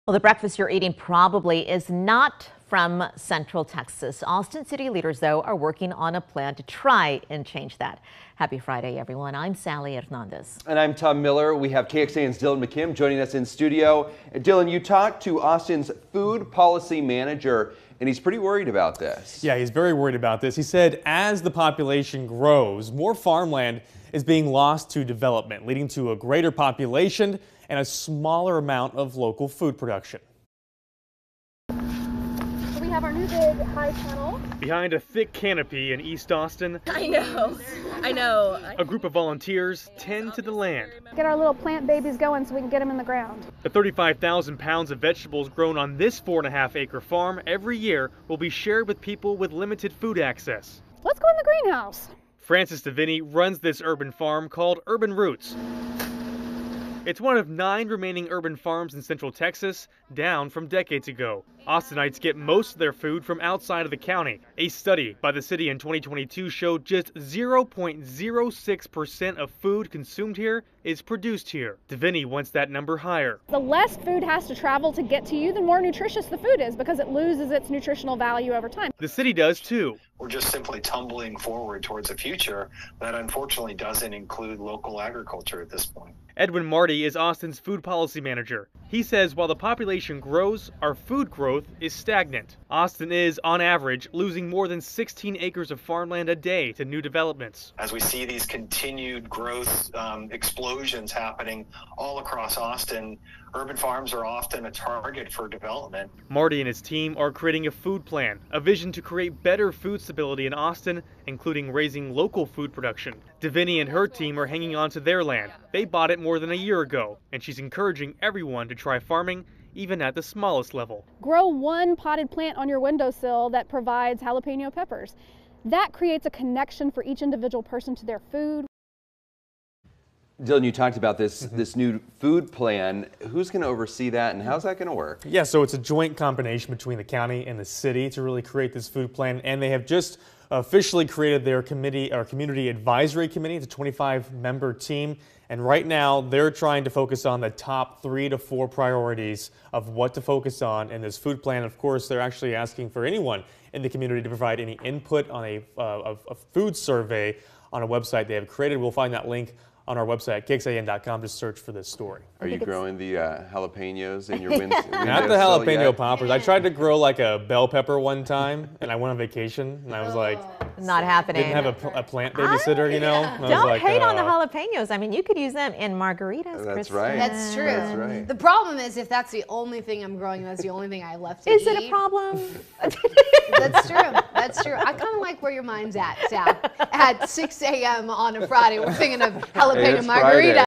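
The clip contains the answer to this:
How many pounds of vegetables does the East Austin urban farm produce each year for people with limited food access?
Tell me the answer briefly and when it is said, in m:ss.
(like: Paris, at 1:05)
35,000, at 0:43.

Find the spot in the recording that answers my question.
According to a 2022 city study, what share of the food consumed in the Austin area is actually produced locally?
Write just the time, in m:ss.
1:07.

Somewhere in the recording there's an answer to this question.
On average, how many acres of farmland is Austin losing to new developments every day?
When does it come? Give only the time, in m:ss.
1:34.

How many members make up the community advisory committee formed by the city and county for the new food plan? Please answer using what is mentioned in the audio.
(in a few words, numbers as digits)
25.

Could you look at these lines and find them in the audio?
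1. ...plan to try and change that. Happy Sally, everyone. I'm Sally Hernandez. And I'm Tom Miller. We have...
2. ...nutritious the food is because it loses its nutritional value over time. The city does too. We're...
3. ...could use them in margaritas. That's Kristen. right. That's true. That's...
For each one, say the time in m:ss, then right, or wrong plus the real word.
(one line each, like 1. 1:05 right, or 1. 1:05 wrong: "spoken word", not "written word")
1. 0:06 wrong: "Friday", not "Sally"
2. 1:15 right
3. 2:55 right.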